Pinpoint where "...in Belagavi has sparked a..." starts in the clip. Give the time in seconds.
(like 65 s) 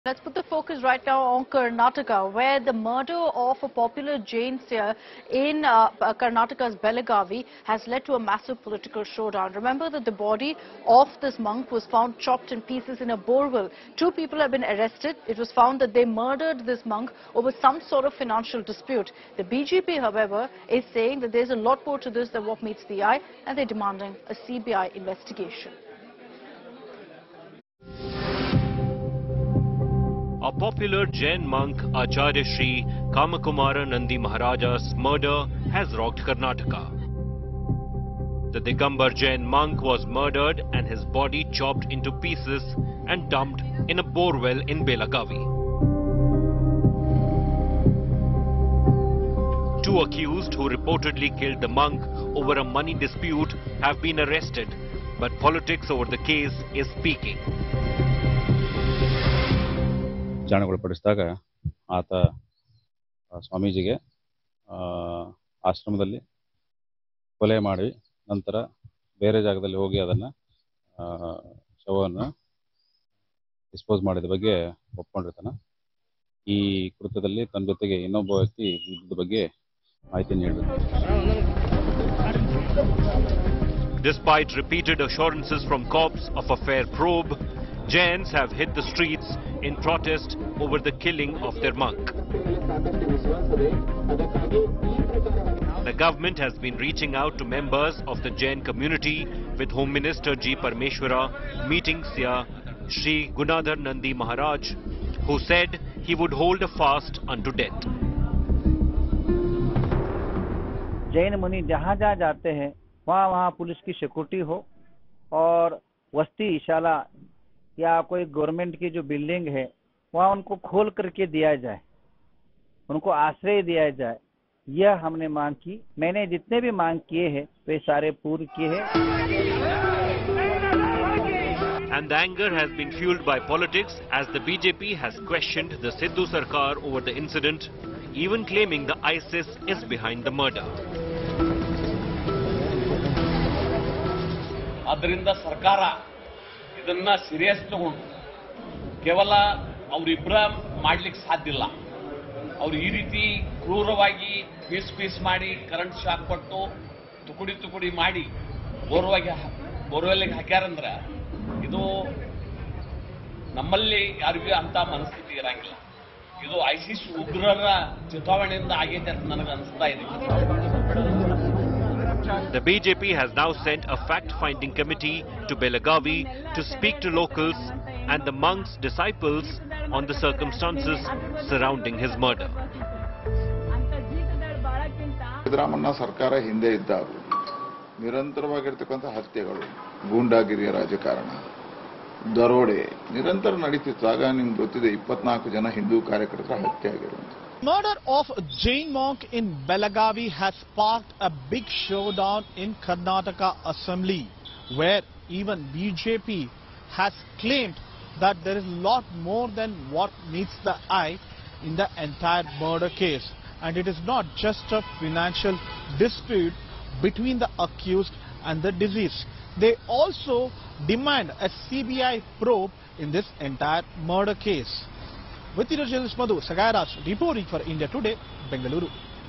199 s.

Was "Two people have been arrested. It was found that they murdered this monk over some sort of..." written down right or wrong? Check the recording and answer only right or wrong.
right.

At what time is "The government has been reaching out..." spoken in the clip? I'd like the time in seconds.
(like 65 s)
95 s.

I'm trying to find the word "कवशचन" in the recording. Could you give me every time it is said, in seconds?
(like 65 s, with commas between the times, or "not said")
135 s.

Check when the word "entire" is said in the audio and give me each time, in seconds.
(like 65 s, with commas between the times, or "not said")
212 s, 223 s.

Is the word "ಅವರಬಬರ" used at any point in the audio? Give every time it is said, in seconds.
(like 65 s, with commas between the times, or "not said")
149 s.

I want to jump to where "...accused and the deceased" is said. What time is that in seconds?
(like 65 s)
217 s.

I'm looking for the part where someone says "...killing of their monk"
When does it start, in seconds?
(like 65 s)
90 s.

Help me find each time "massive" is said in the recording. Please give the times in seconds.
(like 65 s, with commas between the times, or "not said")
8 s.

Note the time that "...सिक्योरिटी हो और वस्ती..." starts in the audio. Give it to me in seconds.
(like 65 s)
113 s.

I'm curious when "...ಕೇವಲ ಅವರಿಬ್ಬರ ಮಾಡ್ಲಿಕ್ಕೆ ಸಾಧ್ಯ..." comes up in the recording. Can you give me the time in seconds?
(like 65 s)
149 s.